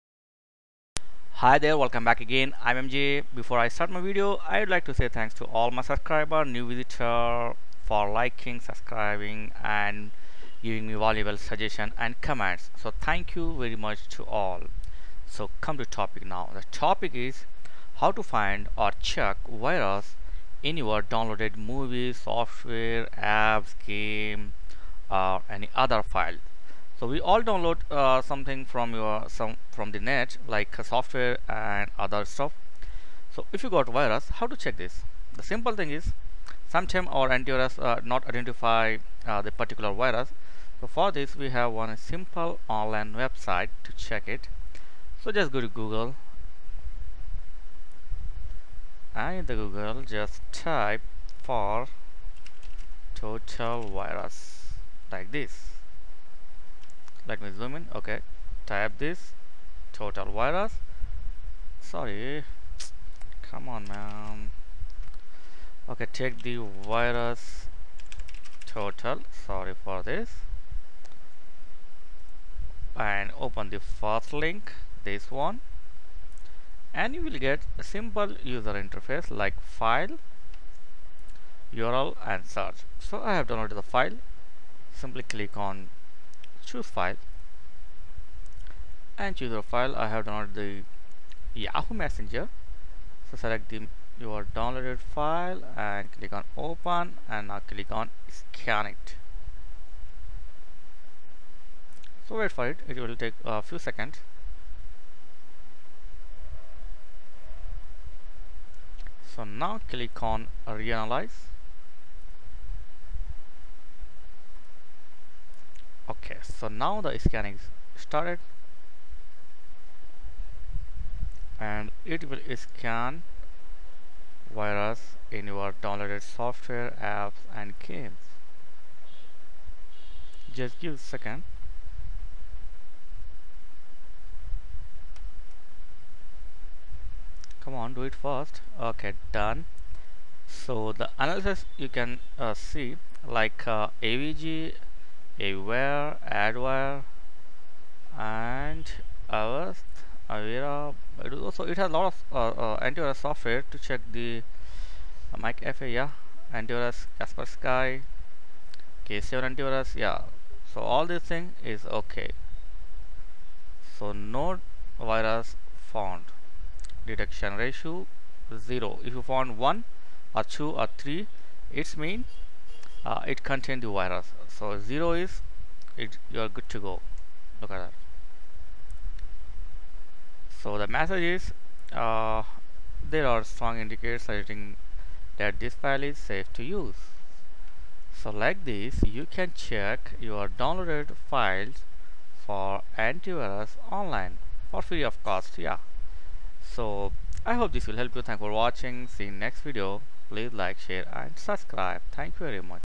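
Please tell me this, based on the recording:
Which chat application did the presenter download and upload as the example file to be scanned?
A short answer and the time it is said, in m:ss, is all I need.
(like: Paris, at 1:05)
Yahoo Messenger, at 1:31.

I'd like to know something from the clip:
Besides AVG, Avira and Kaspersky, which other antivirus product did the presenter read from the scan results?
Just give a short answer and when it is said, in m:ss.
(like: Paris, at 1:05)
K7 antivirus, at 2:39.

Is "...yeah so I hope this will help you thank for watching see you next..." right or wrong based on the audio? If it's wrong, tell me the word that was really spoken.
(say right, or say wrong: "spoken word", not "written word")
right.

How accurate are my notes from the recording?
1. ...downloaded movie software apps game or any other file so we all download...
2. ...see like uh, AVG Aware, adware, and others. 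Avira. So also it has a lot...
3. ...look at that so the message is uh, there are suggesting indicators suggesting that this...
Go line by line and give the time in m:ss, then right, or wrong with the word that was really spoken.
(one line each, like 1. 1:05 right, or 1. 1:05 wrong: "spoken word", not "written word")
1. 0:21 right
2. 2:22 right
3. 2:57 wrong: "strong", not "suggesting".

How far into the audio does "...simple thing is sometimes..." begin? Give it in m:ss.
0:35.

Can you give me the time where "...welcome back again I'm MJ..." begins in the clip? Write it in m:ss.
0:01.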